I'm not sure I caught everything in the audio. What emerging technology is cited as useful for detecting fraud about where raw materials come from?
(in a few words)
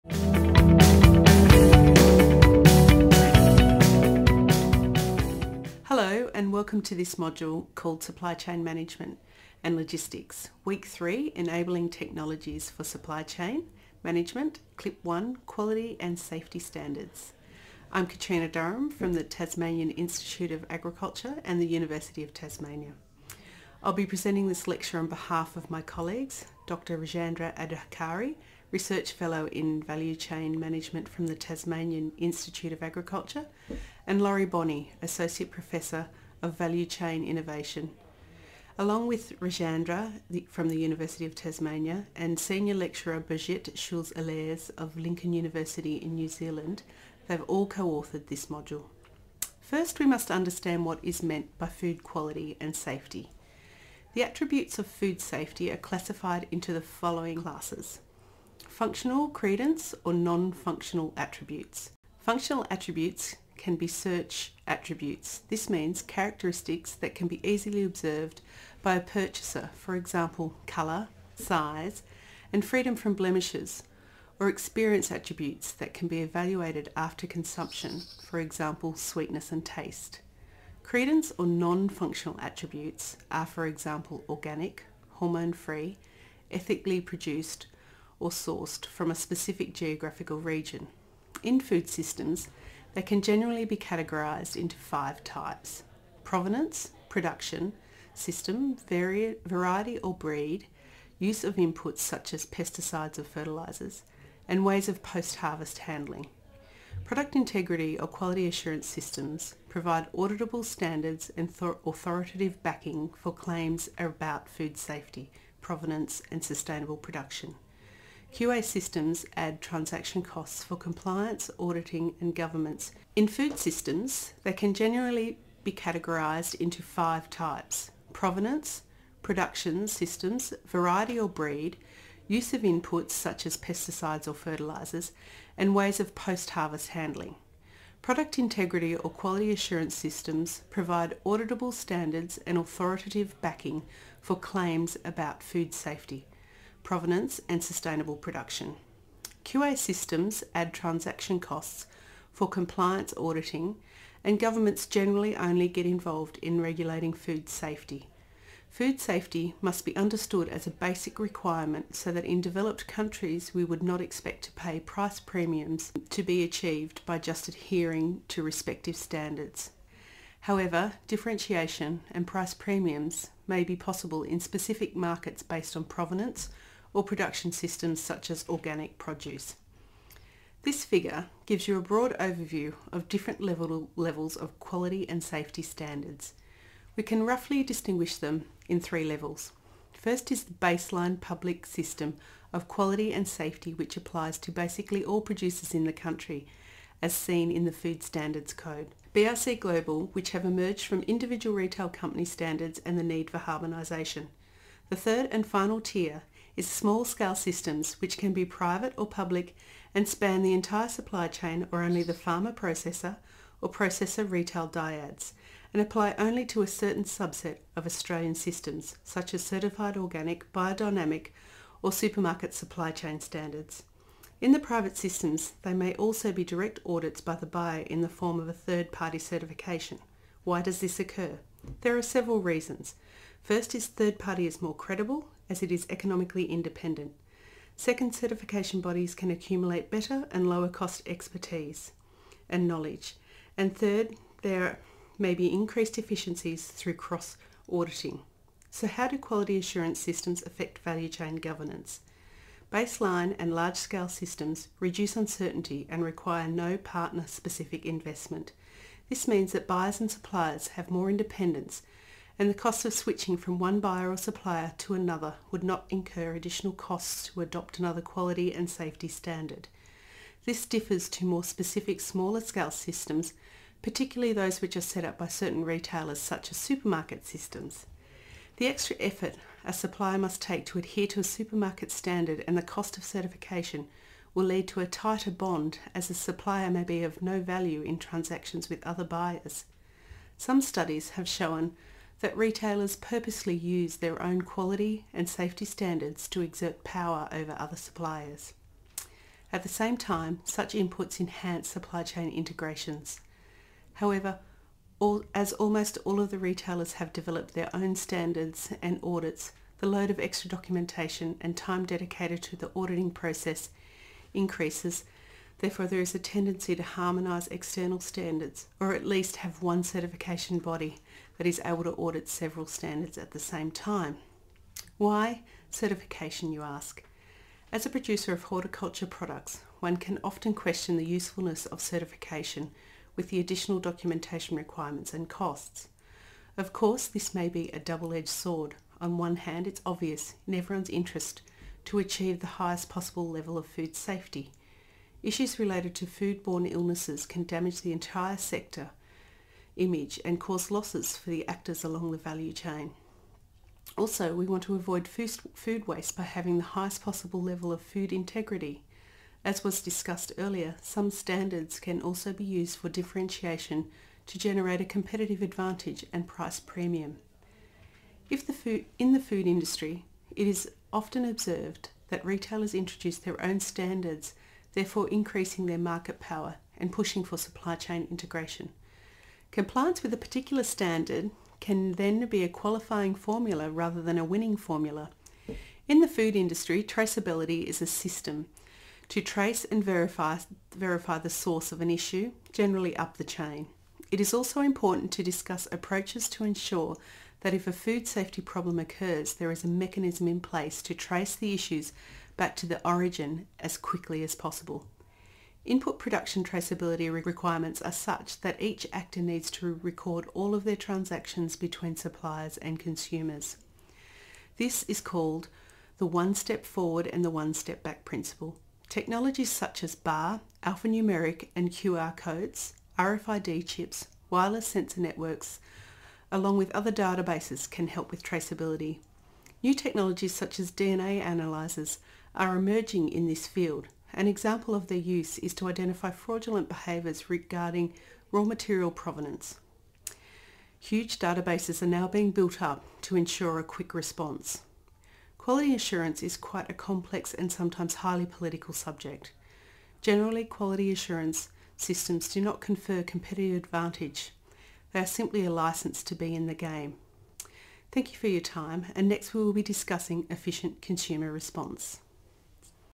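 DNA analyzers.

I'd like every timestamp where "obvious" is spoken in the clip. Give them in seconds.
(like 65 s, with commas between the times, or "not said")
339 s.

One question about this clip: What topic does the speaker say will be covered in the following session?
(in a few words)
efficient consumer response.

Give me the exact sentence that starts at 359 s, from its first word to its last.
As was discussed earlier, some standards can also be used for differentiation to generate a competitive advantage and price premium.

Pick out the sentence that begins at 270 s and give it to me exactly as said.
This differs to more specific smaller scale systems, particularly those which are set up by certain retailers such as supermarket systems.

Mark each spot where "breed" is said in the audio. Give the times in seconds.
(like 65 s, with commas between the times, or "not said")
100 s, 131 s.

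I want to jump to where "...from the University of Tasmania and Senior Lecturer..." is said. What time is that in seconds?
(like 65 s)
40 s.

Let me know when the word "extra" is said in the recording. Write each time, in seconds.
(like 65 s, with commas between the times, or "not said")
278 s, 310 s.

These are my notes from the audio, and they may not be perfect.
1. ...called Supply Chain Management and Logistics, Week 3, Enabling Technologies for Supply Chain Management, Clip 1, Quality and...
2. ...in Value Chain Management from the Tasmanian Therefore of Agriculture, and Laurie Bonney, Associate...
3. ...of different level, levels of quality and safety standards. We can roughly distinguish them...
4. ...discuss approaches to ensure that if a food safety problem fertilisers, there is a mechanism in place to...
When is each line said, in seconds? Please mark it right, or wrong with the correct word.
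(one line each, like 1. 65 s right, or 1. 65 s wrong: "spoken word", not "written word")
1. 7 s right
2. 29 s wrong: "Institute", not "Therefore"
3. 182 s right
4. 395 s wrong: "occurs", not "fertilisers".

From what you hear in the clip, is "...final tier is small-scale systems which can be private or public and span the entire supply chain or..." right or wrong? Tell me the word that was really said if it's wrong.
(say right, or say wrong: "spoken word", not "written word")
right.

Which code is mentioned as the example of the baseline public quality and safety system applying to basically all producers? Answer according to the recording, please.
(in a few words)
Food Standards Code.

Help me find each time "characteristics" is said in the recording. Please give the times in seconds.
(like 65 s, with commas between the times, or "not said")
66 s.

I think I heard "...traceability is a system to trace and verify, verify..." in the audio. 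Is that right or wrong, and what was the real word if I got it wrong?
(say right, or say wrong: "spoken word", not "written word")
right.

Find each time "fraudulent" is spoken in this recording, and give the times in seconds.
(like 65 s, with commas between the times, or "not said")
436 s.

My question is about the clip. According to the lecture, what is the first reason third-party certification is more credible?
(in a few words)
economically independent.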